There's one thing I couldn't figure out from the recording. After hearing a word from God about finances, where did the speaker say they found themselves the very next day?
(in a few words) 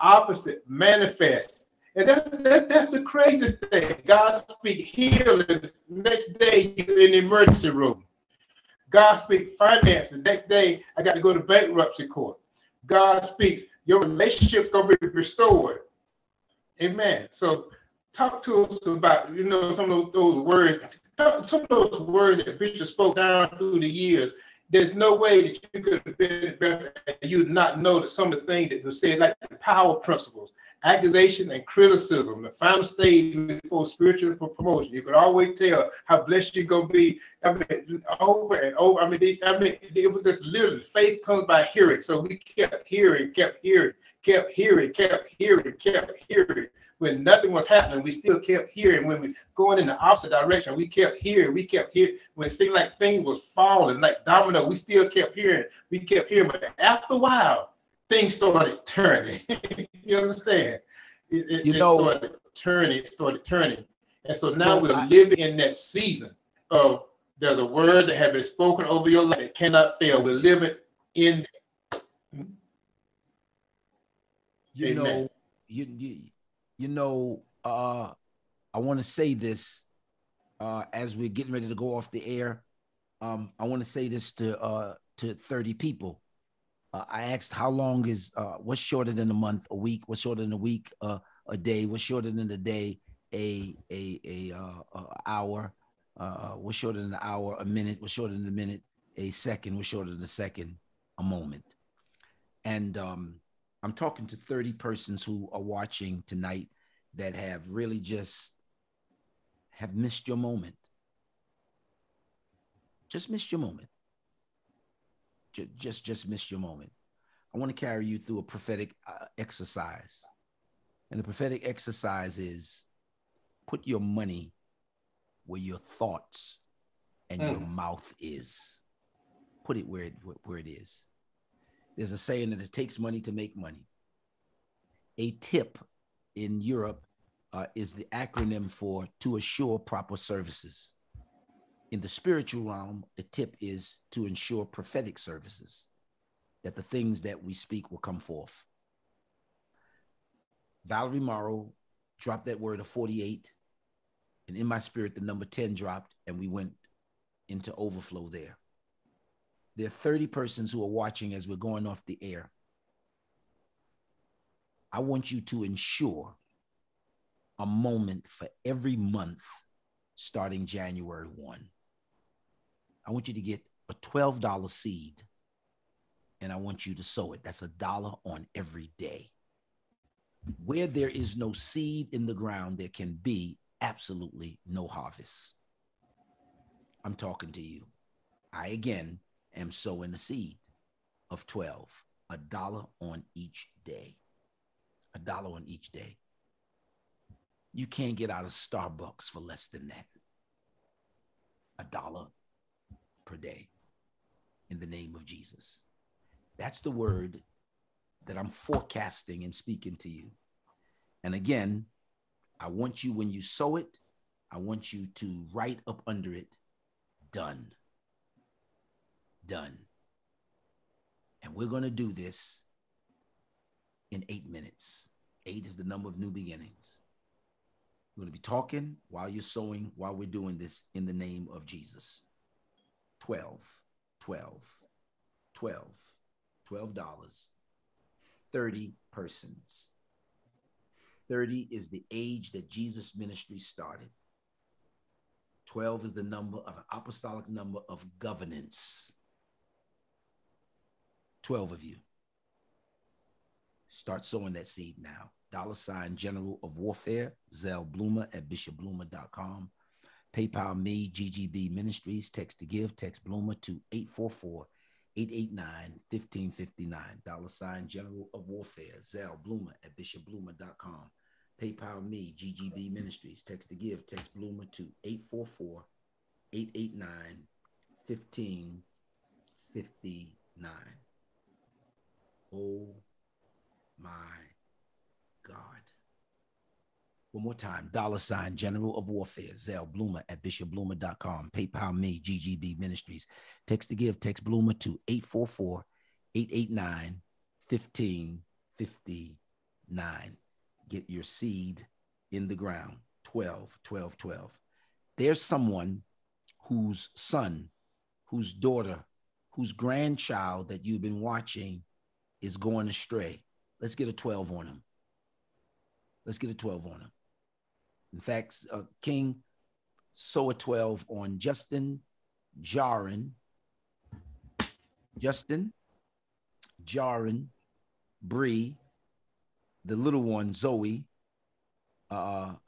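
Bankruptcy court.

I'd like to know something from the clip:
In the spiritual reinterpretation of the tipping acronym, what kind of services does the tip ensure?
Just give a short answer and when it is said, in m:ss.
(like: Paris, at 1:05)
Prophetic services, at 2:24.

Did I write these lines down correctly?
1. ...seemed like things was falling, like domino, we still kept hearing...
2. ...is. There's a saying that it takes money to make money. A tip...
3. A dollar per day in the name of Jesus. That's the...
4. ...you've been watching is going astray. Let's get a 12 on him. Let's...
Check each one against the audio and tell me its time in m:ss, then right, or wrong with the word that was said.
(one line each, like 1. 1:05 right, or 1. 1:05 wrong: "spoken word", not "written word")
1. 0:52 right
2. 2:10 right
3. 3:21 right
4. 5:10 right.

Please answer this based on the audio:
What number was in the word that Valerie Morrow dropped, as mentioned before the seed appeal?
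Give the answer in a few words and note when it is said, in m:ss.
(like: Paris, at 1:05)
48, at 2:32.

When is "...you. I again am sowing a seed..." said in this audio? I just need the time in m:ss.
3:07.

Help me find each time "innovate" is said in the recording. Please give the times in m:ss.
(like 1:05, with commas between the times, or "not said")
not said.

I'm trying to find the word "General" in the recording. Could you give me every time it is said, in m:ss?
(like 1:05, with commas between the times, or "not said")
4:16, 4:27, 4:48.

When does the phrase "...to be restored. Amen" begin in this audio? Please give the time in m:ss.
0:14.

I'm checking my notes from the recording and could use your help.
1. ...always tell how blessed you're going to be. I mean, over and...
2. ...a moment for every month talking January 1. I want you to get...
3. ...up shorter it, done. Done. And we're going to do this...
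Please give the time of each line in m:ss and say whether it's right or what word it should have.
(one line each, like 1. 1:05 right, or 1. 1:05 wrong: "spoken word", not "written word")
1. 0:35 right
2. 2:47 wrong: "starting", not "talking"
3. 3:35 wrong: "under", not "shorter".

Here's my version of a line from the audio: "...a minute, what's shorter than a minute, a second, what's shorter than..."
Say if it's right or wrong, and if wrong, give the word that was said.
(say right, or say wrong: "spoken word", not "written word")
right.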